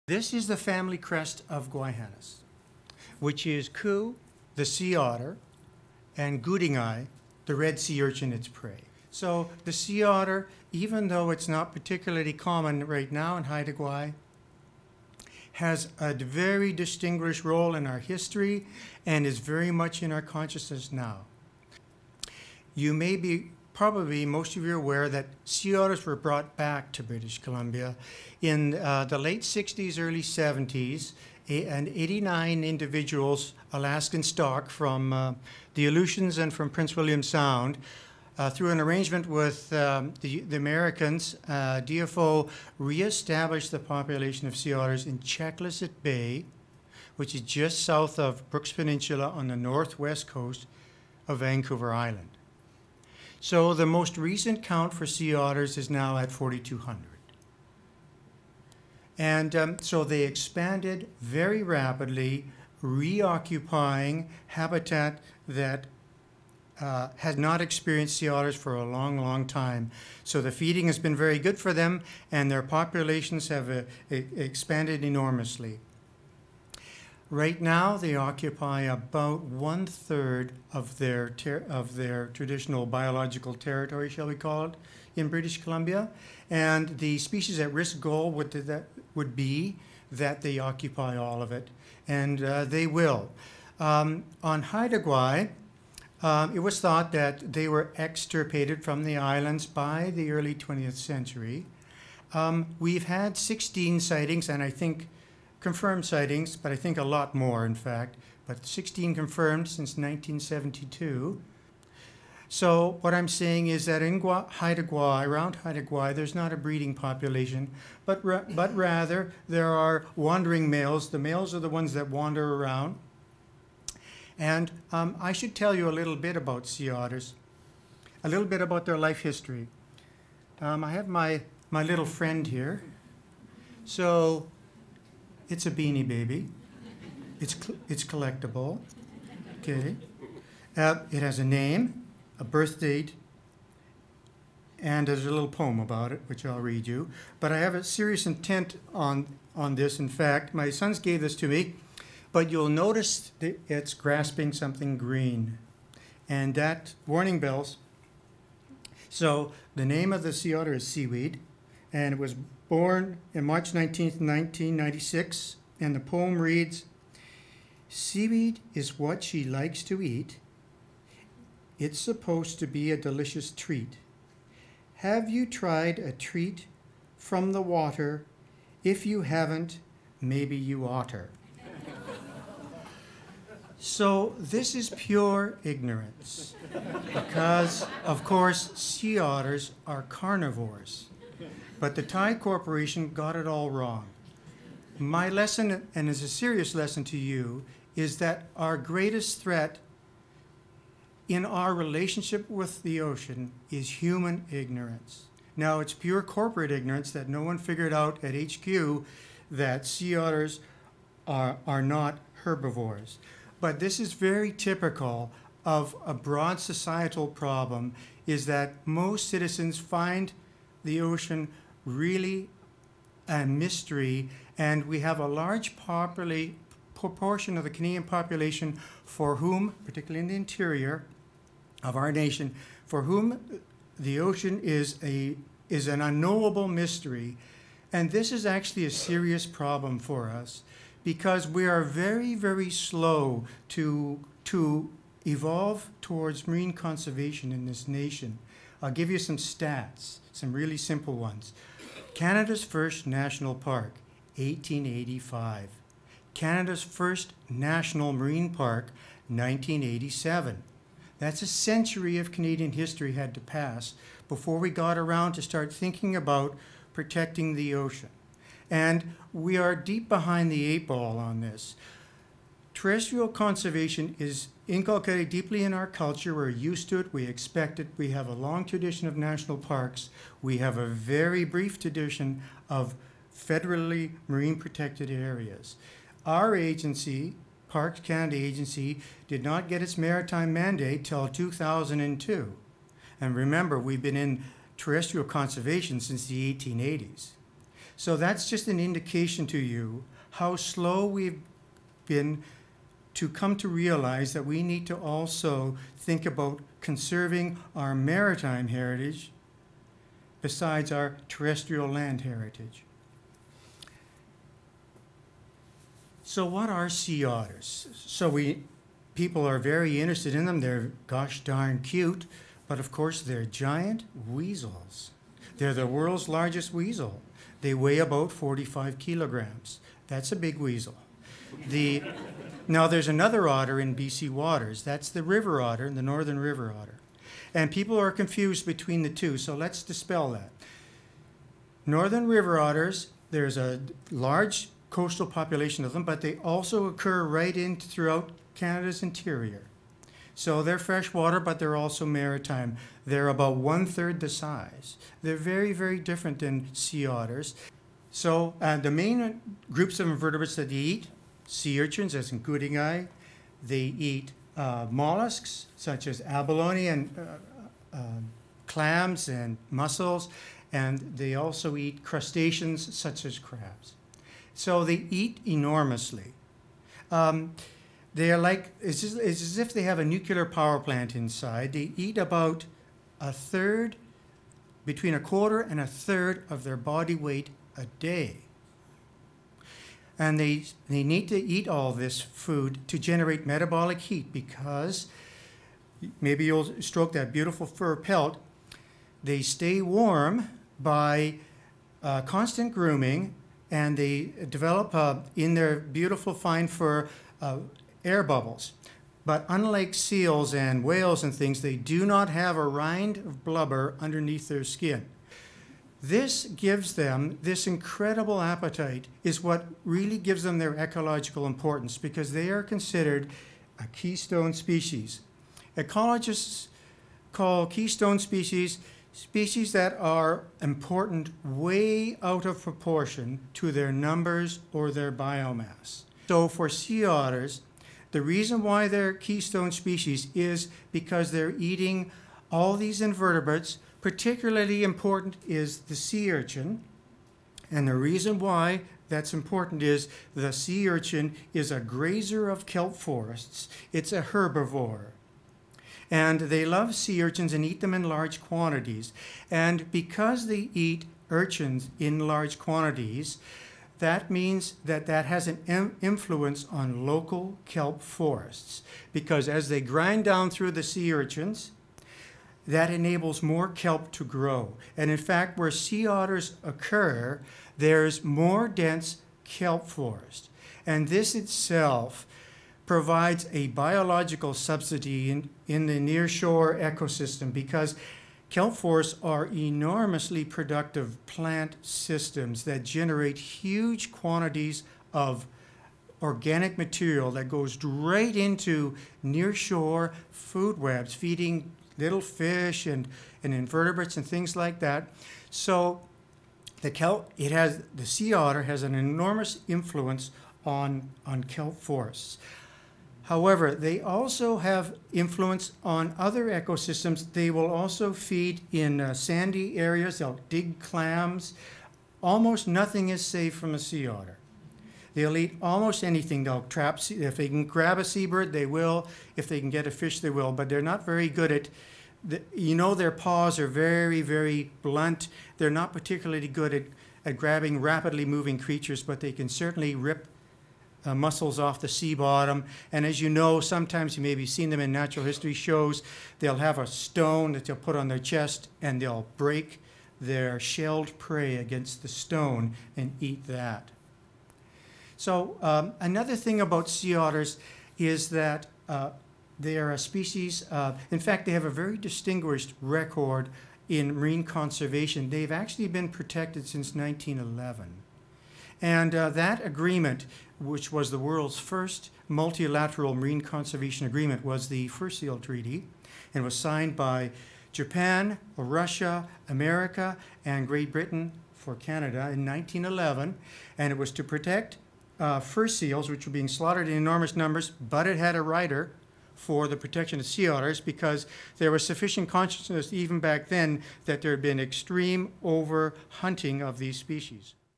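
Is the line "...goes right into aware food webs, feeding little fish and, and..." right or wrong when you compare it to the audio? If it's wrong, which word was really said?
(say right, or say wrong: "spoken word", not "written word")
wrong: "nearshore", not "aware".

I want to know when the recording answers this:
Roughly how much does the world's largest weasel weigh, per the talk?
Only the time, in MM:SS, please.
05:28.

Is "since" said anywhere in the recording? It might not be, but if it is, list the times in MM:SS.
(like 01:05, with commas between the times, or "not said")
01:49, 04:55, 09:26.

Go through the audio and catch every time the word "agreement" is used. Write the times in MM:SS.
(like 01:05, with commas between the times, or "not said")
09:29, 09:34.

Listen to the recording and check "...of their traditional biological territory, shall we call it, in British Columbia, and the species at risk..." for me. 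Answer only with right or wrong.
right.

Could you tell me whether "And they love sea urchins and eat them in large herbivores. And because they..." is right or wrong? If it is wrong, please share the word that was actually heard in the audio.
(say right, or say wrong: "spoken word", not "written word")
wrong: "quantities", not "herbivores".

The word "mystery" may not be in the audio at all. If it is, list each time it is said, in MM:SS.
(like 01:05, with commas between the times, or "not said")
03:43, 03:56.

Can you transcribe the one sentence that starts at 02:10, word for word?
Um, I have my, my little friend here.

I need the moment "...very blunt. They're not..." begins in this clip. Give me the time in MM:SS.
08:54.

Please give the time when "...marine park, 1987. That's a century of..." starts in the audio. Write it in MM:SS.
04:18.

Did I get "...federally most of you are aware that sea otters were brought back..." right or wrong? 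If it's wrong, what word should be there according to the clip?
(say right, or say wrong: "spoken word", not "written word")
wrong: "probably", not "federally".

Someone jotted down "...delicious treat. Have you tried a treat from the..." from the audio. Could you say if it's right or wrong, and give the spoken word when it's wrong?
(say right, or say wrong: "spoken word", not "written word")
right.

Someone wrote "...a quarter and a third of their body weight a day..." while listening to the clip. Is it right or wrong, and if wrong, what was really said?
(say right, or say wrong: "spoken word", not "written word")
right.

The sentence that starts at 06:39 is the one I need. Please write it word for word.
They stay warm by uh, constant grooming and they develop uh, in their beautiful fine fur uh, air bubbles.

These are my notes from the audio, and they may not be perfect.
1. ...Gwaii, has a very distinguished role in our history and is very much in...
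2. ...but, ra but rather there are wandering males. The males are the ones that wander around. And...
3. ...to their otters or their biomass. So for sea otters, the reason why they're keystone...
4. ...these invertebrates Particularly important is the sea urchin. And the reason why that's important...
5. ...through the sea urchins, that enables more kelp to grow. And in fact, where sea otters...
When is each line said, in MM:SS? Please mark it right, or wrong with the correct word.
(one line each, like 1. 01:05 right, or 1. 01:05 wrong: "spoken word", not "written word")
1. 00:13 right
2. 01:58 right
3. 07:13 wrong: "numbers", not "otters"
4. 07:22 right
5. 07:50 right.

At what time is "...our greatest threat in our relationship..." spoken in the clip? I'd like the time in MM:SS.
03:18.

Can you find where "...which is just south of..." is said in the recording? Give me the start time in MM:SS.
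00:47.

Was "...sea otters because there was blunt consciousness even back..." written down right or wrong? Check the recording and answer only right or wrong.
wrong.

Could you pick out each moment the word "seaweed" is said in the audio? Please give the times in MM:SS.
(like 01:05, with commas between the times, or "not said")
02:40, 02:47.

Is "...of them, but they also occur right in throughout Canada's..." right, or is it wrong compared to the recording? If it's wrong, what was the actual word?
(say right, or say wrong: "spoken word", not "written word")
right.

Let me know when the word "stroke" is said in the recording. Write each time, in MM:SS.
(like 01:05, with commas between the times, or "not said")
06:36.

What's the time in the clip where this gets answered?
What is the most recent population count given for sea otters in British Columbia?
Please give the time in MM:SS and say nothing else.
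00:56.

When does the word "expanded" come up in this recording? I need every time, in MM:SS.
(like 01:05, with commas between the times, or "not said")
01:00, 01:14.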